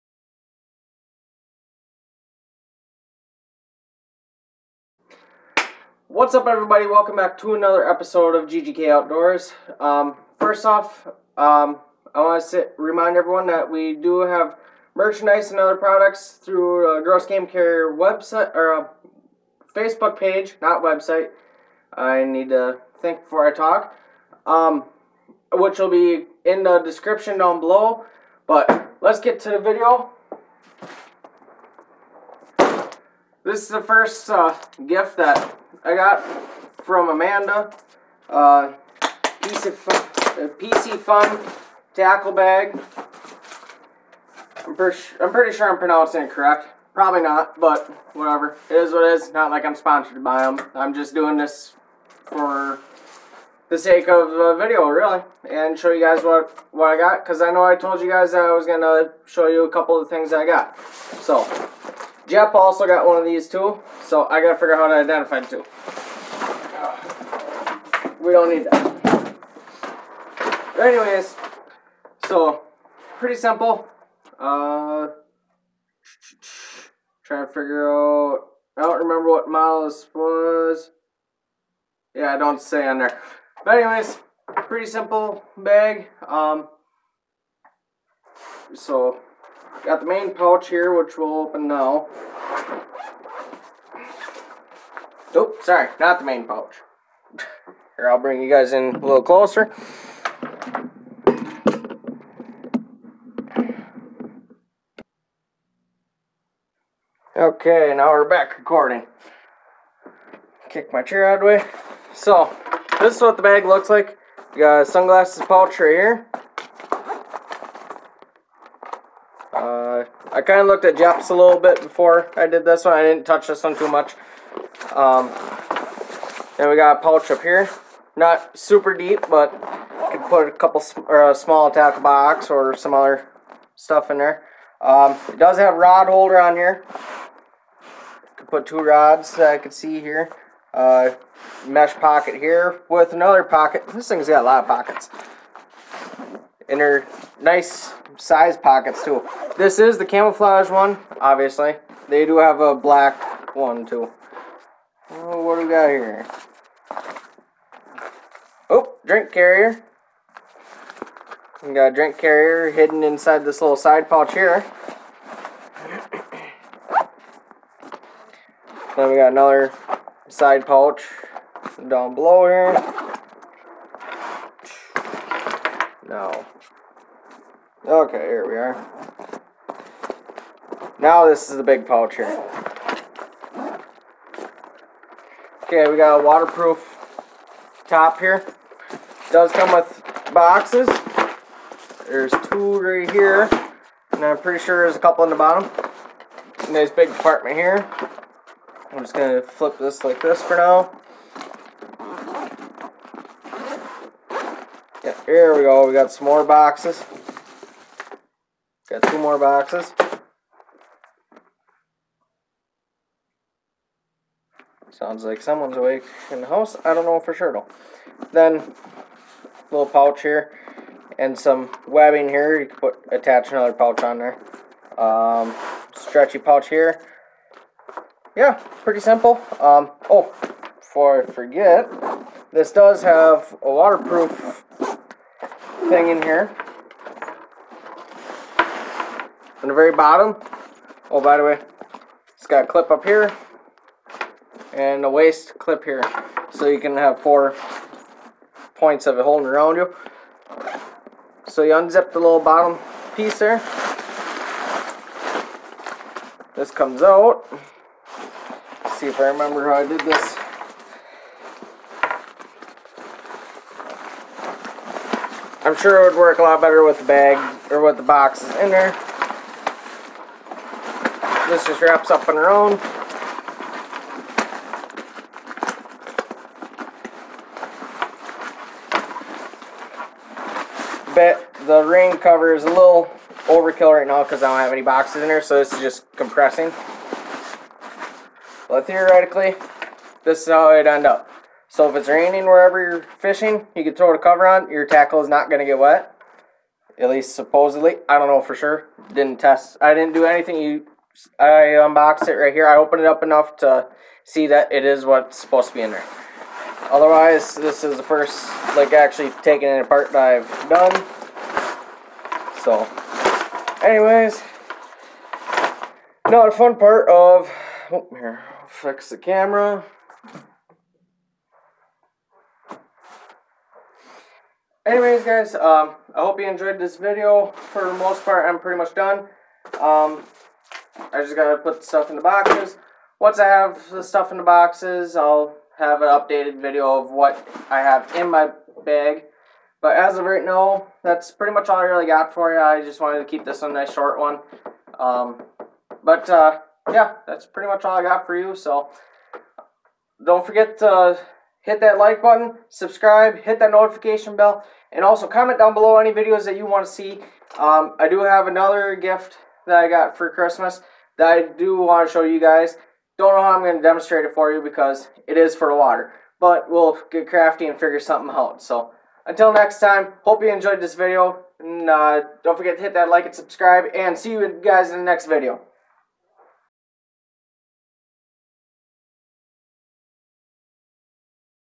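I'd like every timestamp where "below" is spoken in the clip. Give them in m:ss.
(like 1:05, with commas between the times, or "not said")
0:27, 2:52, 5:55.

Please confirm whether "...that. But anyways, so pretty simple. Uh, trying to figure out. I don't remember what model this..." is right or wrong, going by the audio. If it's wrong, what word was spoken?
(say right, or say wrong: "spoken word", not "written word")
right.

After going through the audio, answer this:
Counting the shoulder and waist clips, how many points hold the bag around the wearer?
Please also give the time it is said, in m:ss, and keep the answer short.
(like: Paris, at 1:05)
4, at 4:07.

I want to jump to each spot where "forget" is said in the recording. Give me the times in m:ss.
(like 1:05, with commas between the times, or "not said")
3:51, 5:50, 6:12.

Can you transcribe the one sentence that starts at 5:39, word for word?
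But as of right now, that's pretty much all I really got for you.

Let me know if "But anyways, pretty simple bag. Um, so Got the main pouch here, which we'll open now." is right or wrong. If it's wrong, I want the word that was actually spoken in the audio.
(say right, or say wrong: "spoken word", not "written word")
right.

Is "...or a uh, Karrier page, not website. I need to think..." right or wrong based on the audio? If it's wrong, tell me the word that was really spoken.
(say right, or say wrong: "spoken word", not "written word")
wrong: "Facebook", not "Karrier".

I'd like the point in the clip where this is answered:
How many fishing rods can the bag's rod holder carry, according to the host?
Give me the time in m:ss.
2:18.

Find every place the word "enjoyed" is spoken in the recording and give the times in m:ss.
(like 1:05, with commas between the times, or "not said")
5:26, 6:10.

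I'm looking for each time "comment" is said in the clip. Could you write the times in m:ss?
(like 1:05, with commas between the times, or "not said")
5:55.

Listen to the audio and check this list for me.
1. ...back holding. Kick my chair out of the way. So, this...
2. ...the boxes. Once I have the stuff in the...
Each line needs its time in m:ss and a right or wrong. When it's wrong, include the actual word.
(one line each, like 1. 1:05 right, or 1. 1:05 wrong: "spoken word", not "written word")
1. 1:48 wrong: "recording", not "holding"
2. 5:32 right.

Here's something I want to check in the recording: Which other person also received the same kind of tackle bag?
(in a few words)
Jep.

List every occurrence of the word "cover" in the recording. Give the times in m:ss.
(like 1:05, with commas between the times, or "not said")
4:42, 4:54.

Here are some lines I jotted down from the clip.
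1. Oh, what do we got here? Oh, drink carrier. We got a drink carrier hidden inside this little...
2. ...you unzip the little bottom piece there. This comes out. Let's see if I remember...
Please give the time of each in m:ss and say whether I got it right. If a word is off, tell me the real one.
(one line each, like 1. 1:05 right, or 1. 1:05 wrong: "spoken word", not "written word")
1. 2:35 right
2. 4:11 right.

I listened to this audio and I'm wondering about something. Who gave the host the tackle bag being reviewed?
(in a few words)
Amanda.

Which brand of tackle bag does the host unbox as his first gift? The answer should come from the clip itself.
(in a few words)
Piscifun.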